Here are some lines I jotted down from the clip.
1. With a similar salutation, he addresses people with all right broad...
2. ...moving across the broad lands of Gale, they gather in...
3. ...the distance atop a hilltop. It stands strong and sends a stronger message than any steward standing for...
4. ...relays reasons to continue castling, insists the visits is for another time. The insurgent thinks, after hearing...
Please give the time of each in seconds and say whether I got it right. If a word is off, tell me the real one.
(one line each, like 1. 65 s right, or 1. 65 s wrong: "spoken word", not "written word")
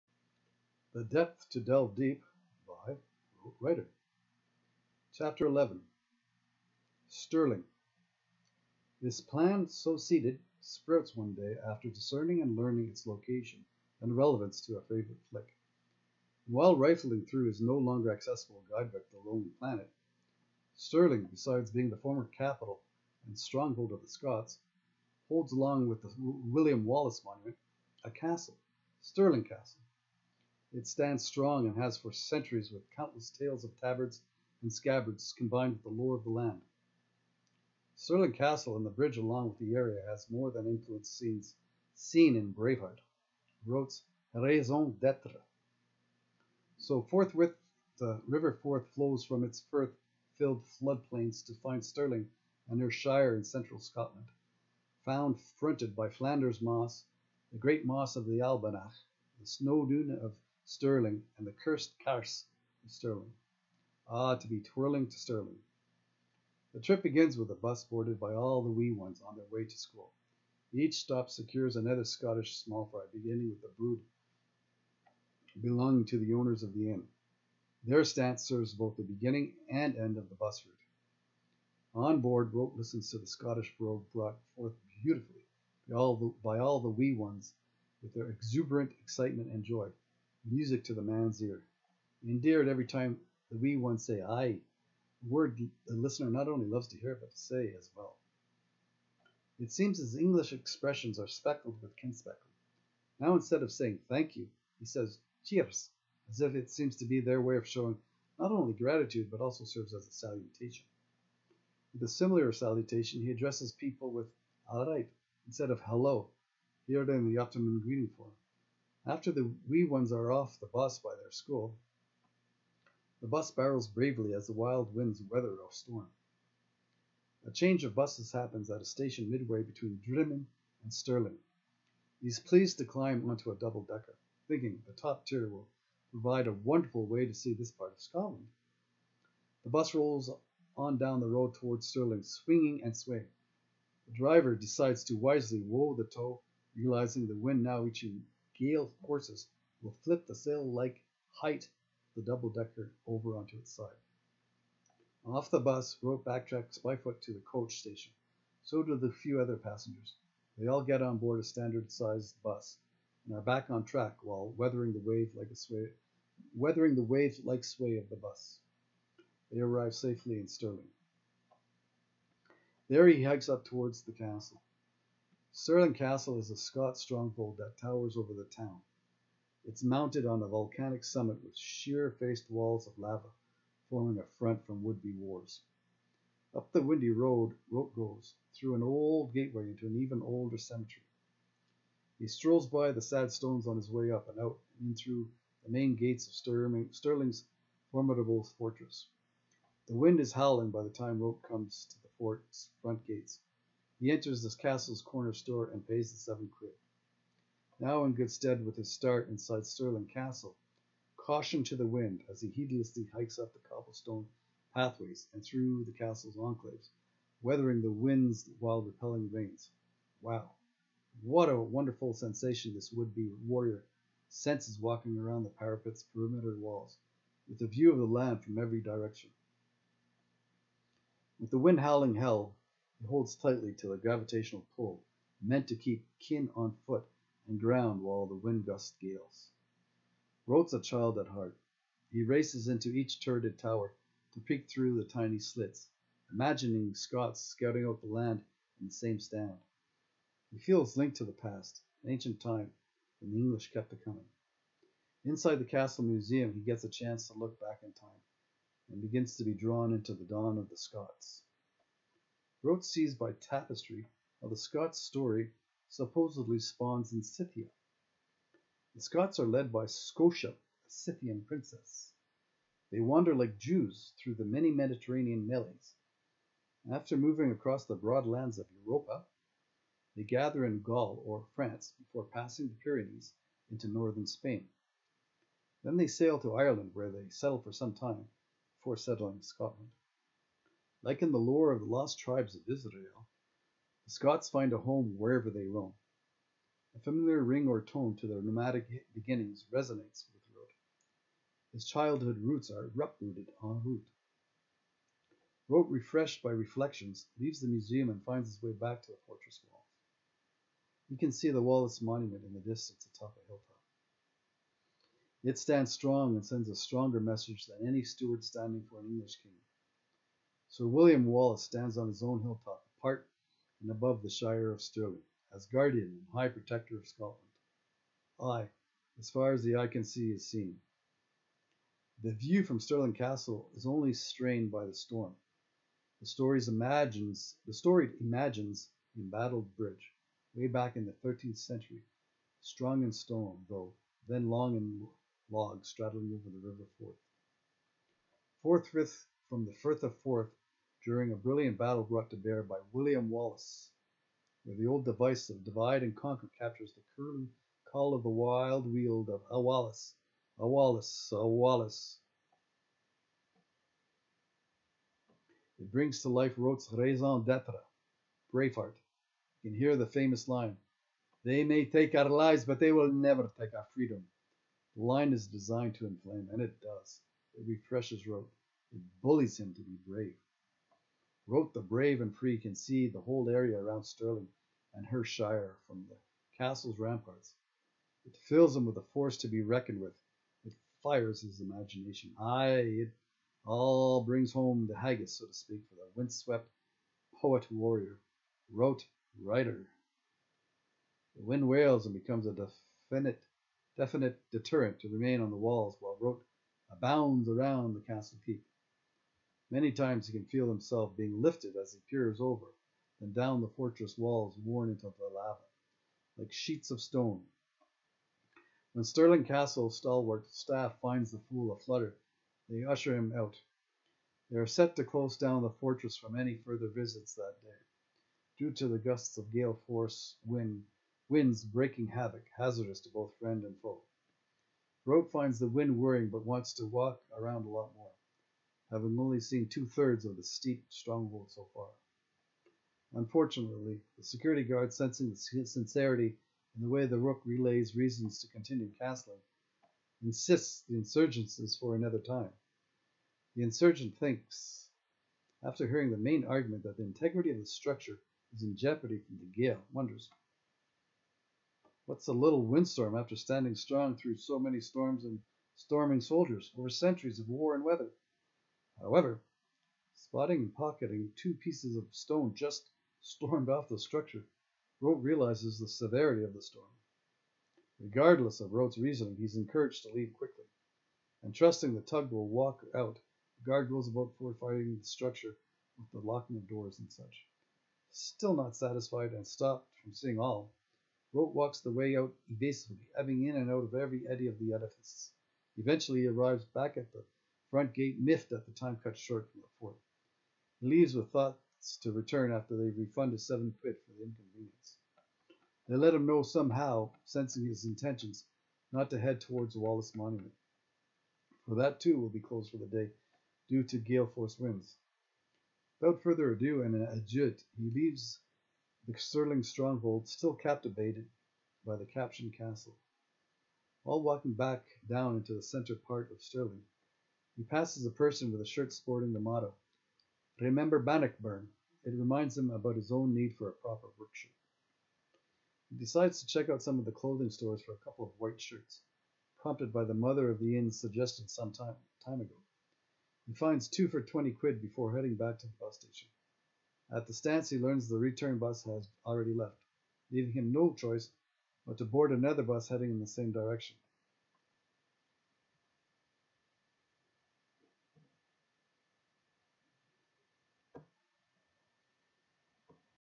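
1. 111 s wrong: "instead", not "broad"
2. 277 s wrong: "Europa", not "Gale"
3. 312 s right
4. 447 s wrong: "insurgents", not "visits".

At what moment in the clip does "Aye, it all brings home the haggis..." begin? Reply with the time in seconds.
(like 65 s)
392 s.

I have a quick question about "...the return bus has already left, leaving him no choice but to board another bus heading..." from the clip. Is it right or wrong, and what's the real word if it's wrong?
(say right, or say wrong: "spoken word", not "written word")
right.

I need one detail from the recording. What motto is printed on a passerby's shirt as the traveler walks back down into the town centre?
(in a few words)
Remember Bannockburn.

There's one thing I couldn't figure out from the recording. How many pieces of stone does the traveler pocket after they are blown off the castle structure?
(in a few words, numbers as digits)
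2.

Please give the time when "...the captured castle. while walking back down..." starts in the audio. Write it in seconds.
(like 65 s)
521 s.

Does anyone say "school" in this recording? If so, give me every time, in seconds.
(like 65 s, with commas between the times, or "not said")
69 s, 121 s.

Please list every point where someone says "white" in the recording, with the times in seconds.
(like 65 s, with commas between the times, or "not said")
538 s.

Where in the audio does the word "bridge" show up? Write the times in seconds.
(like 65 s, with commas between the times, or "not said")
38 s, 339 s.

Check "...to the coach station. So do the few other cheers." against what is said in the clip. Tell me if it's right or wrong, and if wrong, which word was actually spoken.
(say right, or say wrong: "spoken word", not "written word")
wrong: "passengers", not "cheers".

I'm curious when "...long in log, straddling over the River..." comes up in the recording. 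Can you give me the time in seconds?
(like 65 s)
344 s.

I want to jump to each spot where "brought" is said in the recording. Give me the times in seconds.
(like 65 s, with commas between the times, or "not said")
84 s, 352 s.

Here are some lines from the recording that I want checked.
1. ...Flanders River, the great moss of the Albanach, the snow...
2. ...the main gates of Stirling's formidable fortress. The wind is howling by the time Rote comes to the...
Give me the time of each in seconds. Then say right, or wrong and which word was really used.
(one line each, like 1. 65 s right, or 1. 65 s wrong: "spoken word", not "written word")
1. 56 s wrong: "Moss", not "River"
2. 195 s right.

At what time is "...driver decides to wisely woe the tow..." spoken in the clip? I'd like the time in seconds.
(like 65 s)
144 s.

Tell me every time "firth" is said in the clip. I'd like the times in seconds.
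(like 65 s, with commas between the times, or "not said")
49 s, 349 s.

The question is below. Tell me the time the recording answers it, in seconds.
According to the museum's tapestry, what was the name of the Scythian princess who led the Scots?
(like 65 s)
269 s.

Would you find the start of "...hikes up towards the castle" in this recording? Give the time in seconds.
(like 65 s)
173 s.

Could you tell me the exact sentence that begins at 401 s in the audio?
The wind wails and becomes a definite, definite deterrent to remain on the walls while rote abounds around the castle keep.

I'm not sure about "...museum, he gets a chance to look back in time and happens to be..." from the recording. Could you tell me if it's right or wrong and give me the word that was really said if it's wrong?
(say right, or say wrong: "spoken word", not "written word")
wrong: "begins", not "happens".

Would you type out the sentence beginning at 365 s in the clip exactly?
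It brings to life Rote's raison d'etre, Braveheart.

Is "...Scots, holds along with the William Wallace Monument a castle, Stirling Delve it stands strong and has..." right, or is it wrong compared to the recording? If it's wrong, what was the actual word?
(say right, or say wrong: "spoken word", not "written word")
wrong: "Castle", not "Delve".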